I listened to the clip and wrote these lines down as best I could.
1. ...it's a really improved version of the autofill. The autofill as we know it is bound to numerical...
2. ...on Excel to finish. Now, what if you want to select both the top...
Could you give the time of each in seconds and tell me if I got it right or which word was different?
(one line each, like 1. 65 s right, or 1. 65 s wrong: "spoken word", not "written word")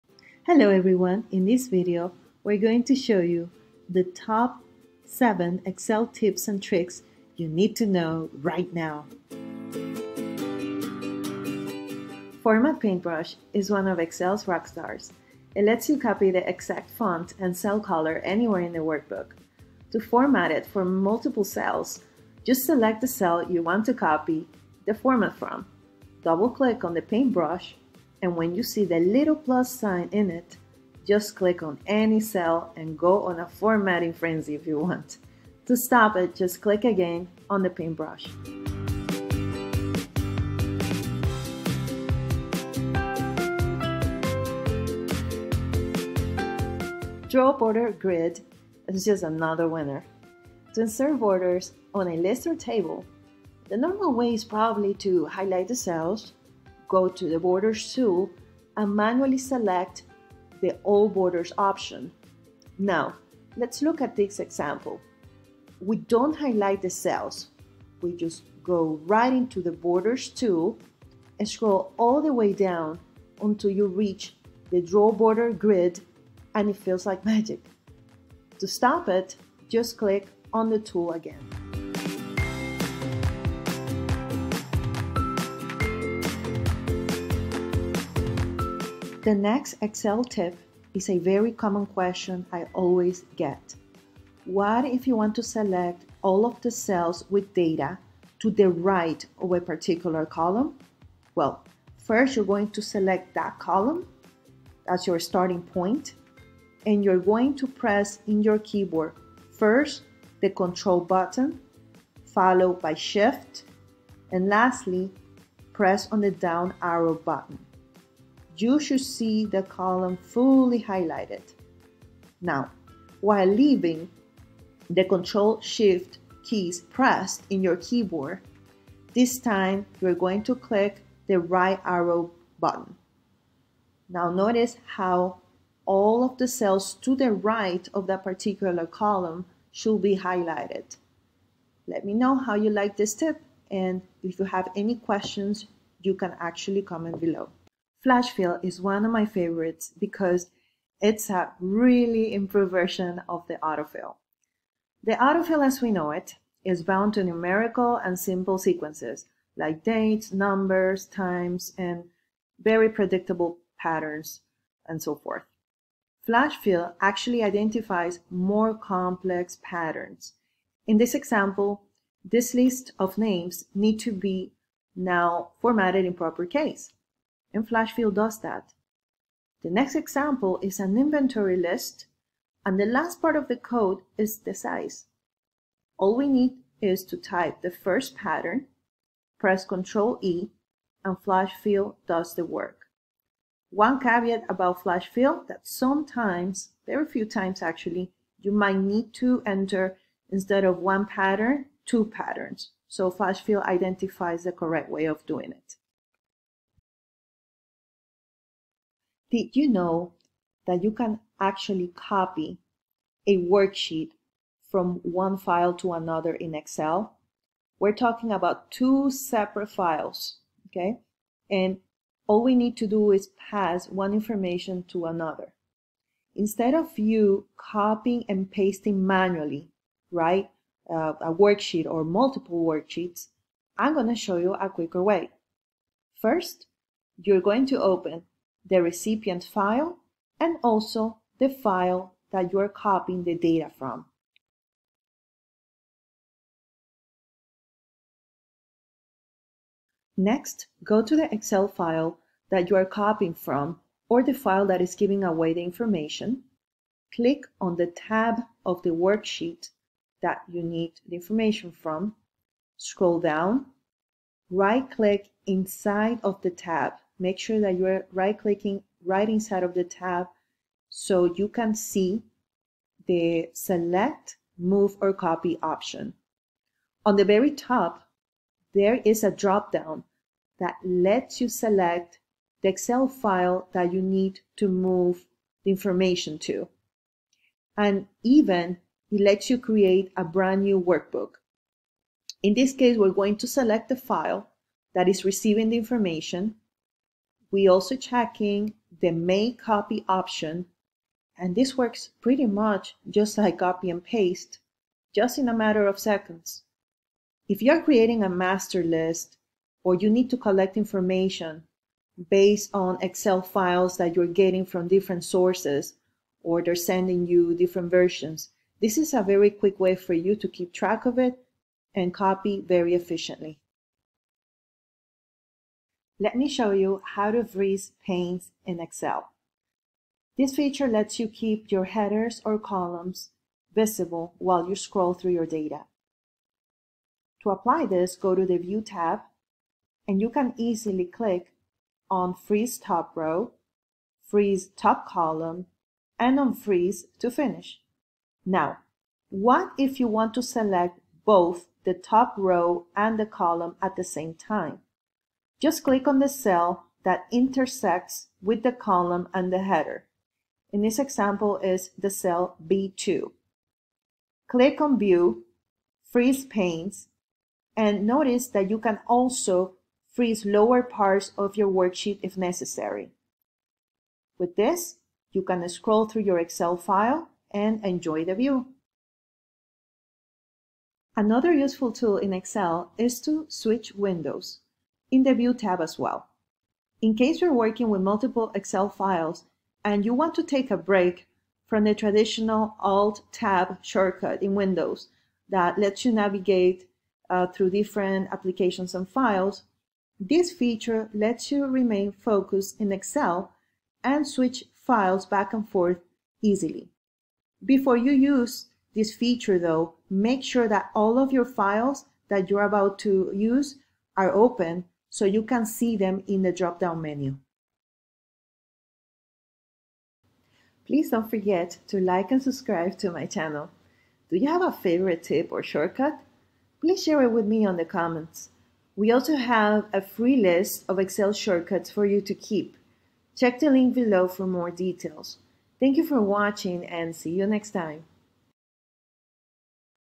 1. 151 s right
2. 346 s wrong: "Freeze", not "Excel".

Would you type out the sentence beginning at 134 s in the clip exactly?
Now notice how all of the cells to the right of that particular column should be highlighted.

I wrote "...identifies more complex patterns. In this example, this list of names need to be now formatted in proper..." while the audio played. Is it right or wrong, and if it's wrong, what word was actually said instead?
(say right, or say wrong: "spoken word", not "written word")
right.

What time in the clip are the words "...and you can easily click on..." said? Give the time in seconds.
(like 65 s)
340 s.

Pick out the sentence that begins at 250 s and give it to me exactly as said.
Next, go to the Excel file that you are copying from or the file that is giving away the information.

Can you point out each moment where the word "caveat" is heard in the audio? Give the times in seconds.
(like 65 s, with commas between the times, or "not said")
193 s.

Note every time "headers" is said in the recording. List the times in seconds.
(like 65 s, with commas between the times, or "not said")
331 s, 359 s.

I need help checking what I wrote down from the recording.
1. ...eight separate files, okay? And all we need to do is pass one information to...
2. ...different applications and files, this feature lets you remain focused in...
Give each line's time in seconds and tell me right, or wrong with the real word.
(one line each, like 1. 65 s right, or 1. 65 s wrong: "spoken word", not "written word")
1. 218 s wrong: "two", not "eight"
2. 397 s right.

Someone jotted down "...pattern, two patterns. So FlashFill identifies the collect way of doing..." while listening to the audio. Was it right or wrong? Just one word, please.
wrong.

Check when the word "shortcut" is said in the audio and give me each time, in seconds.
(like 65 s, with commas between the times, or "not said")
393 s, 425 s, 431 s.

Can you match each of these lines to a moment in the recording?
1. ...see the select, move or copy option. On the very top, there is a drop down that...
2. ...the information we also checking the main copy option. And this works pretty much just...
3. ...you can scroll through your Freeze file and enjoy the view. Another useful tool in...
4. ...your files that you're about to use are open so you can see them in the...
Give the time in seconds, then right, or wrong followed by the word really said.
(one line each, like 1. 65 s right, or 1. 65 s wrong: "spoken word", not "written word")
1. 271 s right
2. 295 s right
3. 375 s wrong: "Excel", not "Freeze"
4. 411 s right.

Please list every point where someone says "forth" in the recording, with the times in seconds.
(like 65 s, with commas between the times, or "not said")
165 s, 405 s.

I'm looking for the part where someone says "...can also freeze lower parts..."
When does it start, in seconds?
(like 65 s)
368 s.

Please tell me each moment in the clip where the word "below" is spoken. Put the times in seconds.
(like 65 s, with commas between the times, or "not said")
147 s, 433 s.